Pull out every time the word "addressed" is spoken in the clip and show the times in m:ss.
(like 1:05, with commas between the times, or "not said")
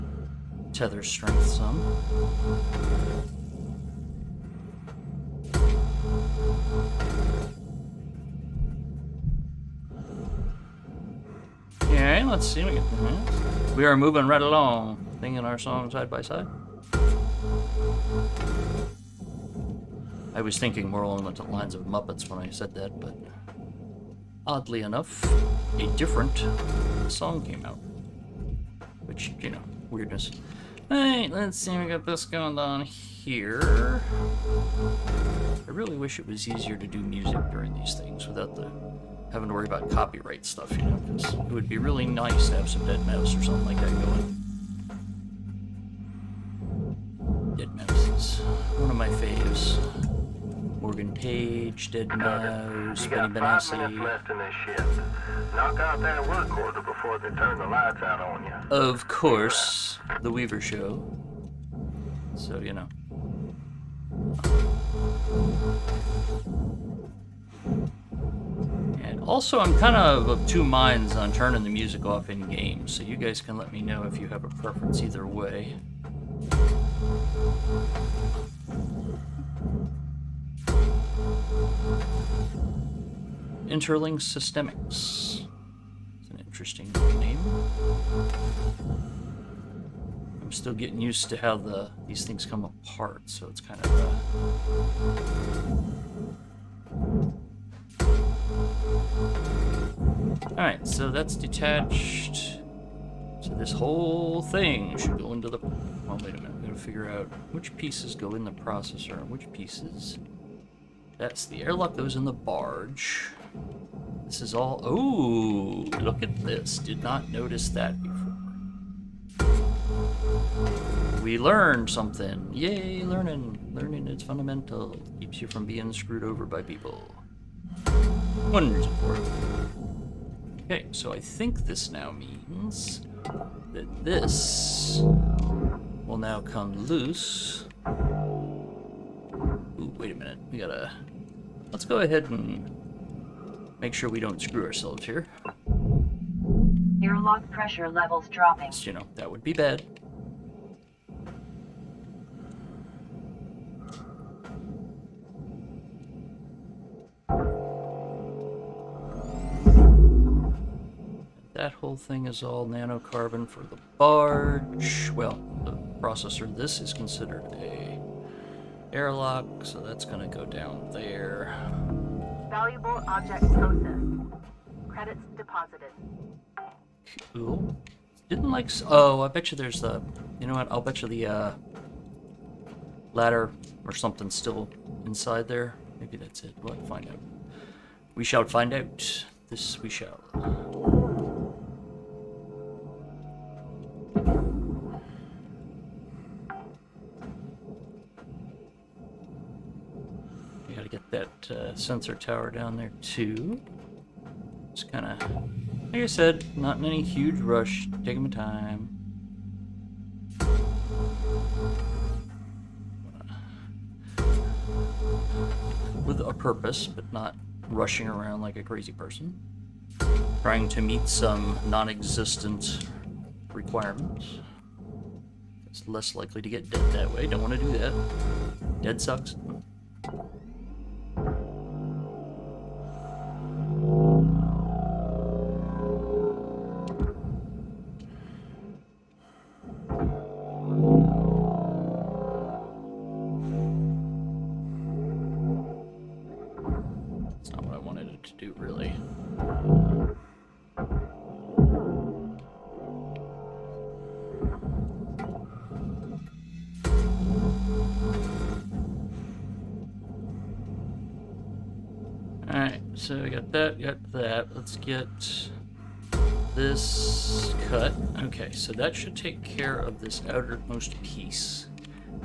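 not said.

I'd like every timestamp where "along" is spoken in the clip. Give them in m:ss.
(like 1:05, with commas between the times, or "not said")
0:14, 0:21.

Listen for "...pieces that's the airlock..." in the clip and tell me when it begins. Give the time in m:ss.
1:49.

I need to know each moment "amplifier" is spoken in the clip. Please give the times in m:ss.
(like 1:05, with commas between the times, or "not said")
not said.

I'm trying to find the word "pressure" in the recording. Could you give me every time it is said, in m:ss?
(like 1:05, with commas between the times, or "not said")
2:27.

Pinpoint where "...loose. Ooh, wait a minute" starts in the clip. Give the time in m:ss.
2:16.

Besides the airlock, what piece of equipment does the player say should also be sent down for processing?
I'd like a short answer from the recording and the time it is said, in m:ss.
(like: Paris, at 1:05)
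sensor tower, at 3:21.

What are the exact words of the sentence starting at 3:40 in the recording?
Trying to meet some non-existent requirements.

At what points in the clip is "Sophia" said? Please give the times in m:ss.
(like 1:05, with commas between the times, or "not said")
not said.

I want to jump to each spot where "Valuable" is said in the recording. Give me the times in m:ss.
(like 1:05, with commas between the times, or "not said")
2:52.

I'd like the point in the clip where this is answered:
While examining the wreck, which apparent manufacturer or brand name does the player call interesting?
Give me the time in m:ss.
1:23.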